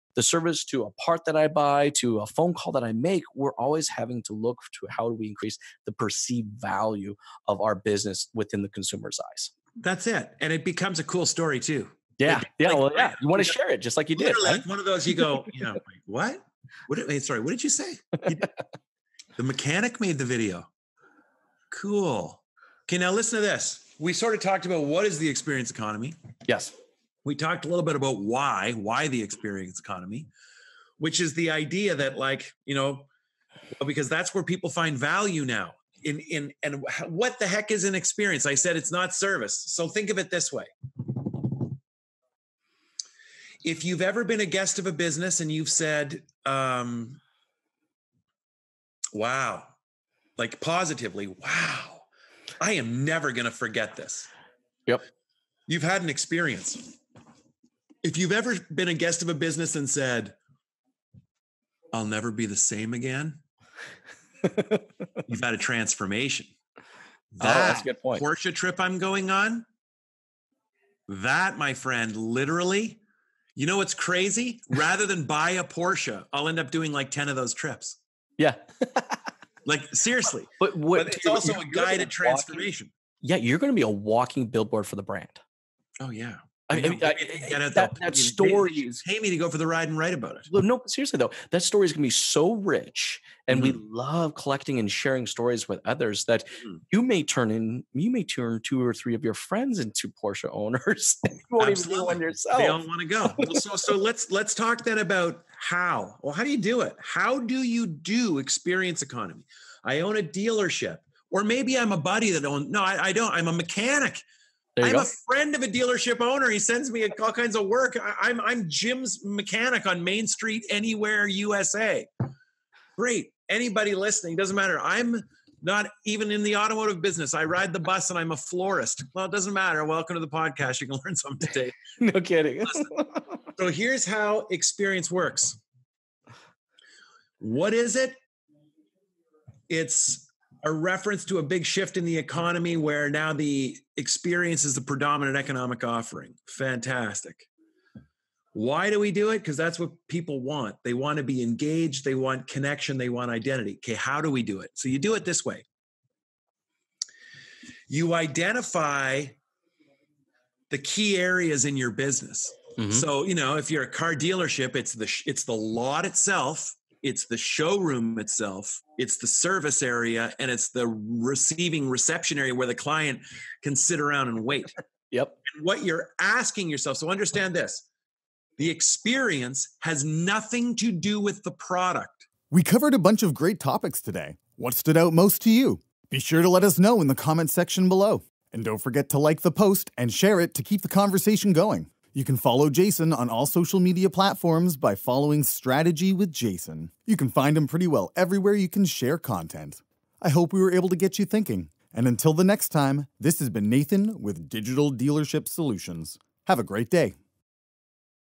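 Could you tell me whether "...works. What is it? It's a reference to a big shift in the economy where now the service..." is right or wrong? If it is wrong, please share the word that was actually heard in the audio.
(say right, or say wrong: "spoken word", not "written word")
wrong: "experience", not "service".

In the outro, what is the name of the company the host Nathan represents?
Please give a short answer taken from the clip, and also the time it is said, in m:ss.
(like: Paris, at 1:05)
Digital Dealership Solutions, at 3:24.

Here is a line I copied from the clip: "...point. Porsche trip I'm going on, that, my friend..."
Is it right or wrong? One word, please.
right.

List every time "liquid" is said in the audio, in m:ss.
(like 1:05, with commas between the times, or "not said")
not said.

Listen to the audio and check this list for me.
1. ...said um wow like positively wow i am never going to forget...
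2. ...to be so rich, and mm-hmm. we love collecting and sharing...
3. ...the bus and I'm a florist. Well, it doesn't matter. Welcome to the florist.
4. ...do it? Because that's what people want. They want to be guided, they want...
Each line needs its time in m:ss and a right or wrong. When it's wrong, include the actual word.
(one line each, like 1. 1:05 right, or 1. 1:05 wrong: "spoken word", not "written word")
1. 0:45 right
2. 1:32 right
3. 2:07 wrong: "podcast", not "florist"
4. 2:29 wrong: "engaged", not "guided".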